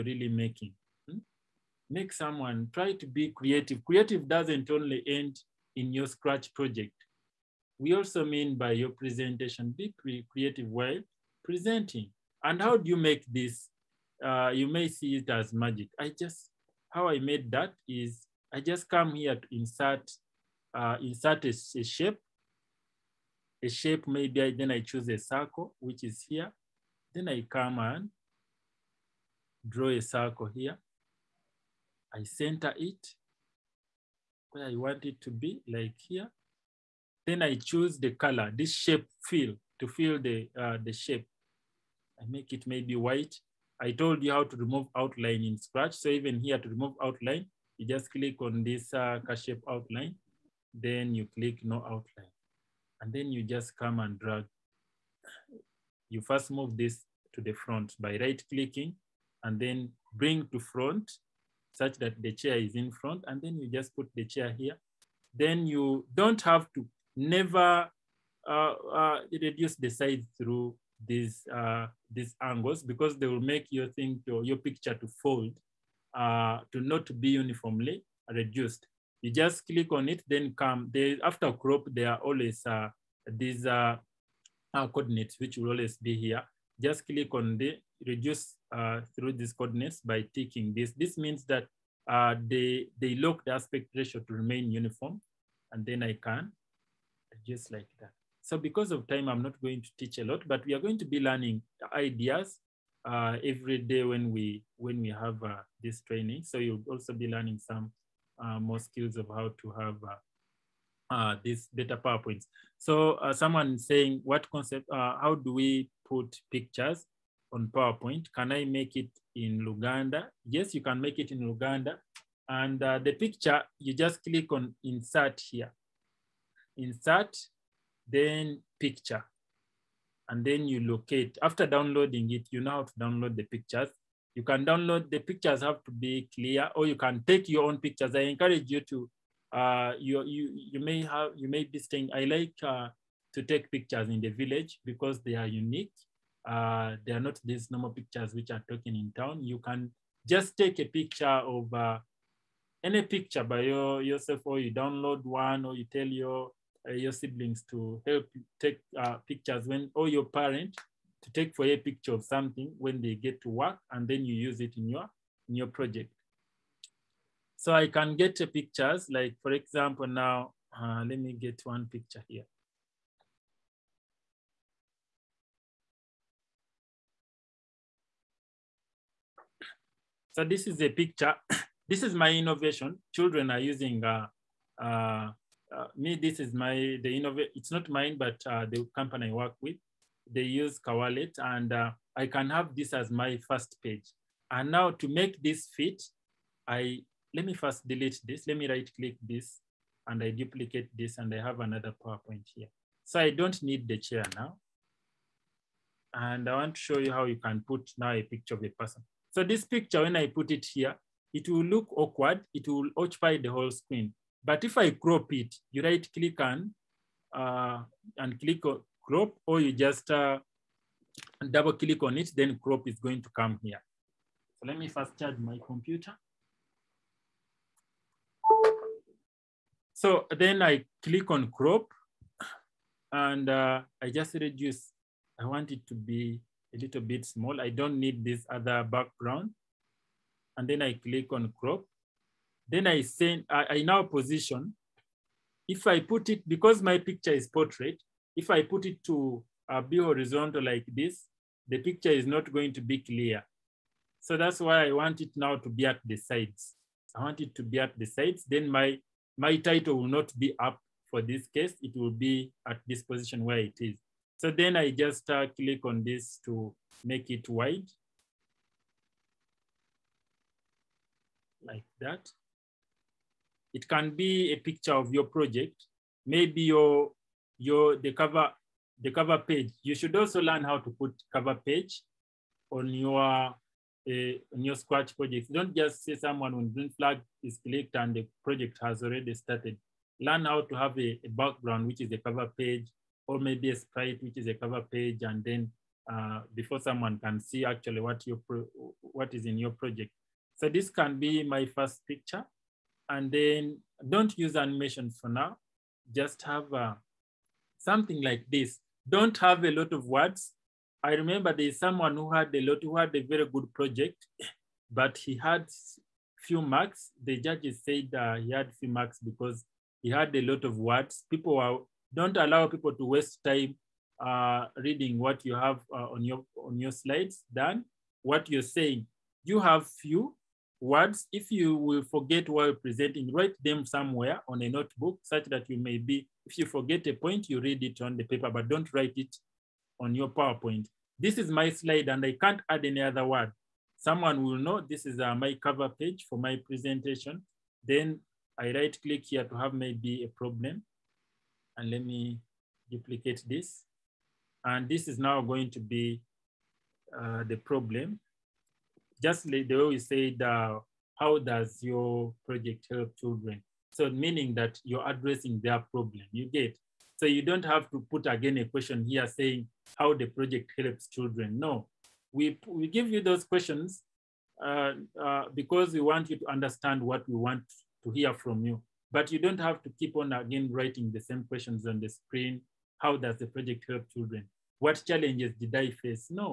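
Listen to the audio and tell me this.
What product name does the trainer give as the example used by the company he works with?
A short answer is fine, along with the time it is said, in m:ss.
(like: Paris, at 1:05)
Kawalet, at 3:10.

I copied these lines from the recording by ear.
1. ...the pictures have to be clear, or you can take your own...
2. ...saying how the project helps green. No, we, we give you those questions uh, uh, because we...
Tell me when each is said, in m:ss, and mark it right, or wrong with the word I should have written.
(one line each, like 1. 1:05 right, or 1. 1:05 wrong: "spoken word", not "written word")
1. 2:15 right
2. 6:09 wrong: "children", not "green".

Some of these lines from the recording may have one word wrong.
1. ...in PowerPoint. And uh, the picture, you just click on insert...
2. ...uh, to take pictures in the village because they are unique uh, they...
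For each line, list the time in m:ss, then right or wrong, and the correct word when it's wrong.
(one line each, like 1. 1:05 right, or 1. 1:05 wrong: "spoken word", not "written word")
1. 2:01 wrong: "Luganda", not "PowerPoint"
2. 2:22 right.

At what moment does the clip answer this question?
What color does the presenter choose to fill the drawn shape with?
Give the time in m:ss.
0:42.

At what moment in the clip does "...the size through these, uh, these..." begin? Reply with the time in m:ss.
1:09.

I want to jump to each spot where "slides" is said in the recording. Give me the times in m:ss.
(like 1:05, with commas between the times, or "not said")
5:26, 5:41.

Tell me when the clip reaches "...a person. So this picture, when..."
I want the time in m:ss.
3:28.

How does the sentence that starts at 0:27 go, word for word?
Then I come and draw a circle here.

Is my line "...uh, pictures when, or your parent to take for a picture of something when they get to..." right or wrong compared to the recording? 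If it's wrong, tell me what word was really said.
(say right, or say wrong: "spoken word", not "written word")
right.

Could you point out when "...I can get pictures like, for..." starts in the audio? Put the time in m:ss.
2:47.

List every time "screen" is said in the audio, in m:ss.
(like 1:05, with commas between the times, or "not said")
3:33, 6:22.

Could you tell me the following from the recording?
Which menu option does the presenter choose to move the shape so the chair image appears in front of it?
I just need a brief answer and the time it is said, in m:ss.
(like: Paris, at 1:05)
Bring to front, at 1:00.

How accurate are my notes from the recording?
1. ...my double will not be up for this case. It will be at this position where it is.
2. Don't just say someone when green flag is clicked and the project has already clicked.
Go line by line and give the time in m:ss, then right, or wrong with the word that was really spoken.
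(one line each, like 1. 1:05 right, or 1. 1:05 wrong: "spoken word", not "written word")
1. 4:19 wrong: "title", not "double"
2. 4:45 wrong: "started", not "clicked".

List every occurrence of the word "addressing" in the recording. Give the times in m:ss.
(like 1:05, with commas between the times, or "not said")
6:05.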